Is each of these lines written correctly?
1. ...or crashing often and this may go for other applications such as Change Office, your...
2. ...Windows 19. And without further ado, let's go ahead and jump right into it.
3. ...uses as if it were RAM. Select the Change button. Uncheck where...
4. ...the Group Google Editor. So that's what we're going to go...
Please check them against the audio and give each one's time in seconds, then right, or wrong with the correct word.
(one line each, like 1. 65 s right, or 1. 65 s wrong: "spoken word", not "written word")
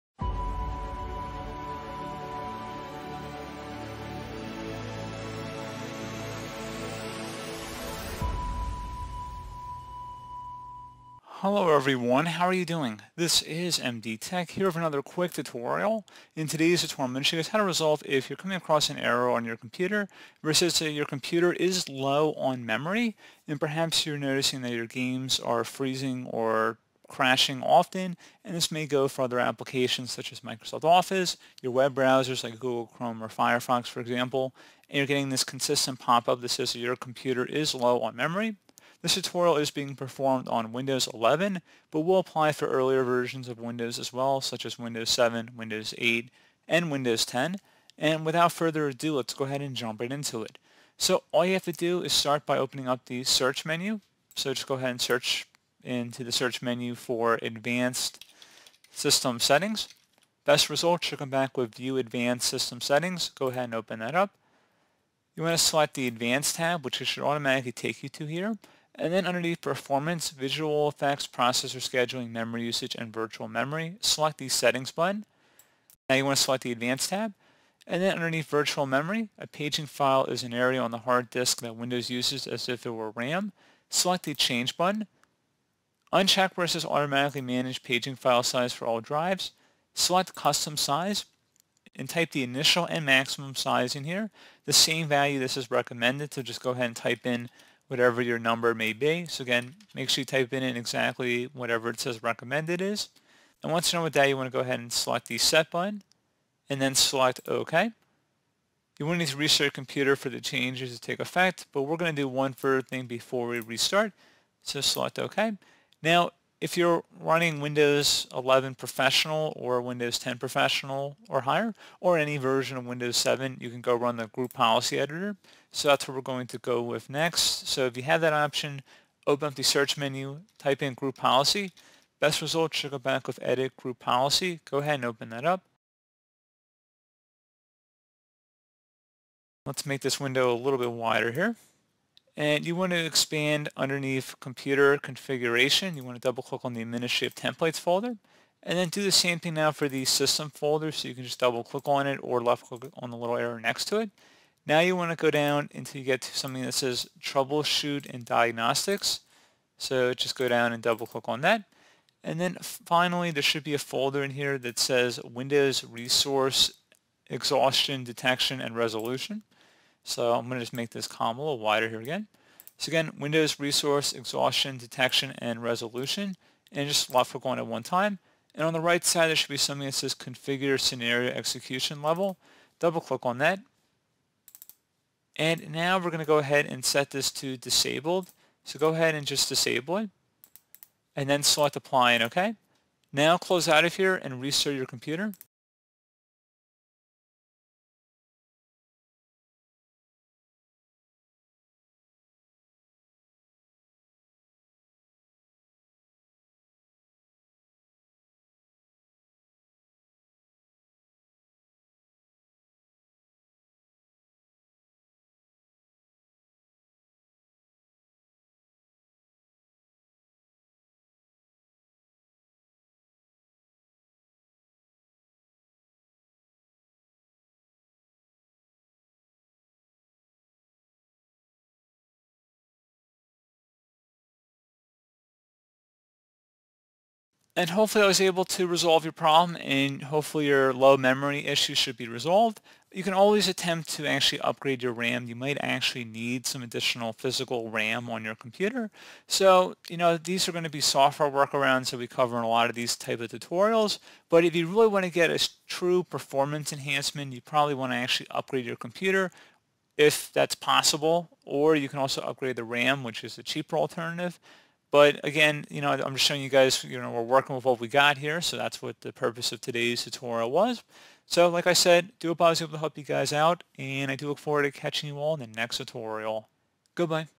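1. 26 s wrong: "Microsoft", not "Change"
2. 46 s wrong: "10", not "19"
3. 82 s right
4. 124 s wrong: "Policy", not "Google".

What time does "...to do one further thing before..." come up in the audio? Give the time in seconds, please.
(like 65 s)
112 s.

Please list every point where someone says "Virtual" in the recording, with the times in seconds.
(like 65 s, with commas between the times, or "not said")
73 s, 78 s.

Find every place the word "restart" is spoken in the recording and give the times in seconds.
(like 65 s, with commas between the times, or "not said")
109 s, 113 s, 194 s.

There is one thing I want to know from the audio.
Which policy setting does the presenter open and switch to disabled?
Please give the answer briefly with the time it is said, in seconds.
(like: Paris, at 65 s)
Configure scenario execution level, at 180 s.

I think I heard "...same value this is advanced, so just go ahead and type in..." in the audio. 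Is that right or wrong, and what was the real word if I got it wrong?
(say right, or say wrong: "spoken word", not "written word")
wrong: "recommended", not "advanced".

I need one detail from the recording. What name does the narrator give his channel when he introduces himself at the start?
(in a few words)
MD Tech.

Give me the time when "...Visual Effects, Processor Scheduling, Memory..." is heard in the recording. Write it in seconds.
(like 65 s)
70 s.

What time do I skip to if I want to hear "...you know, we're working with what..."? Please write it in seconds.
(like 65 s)
266 s.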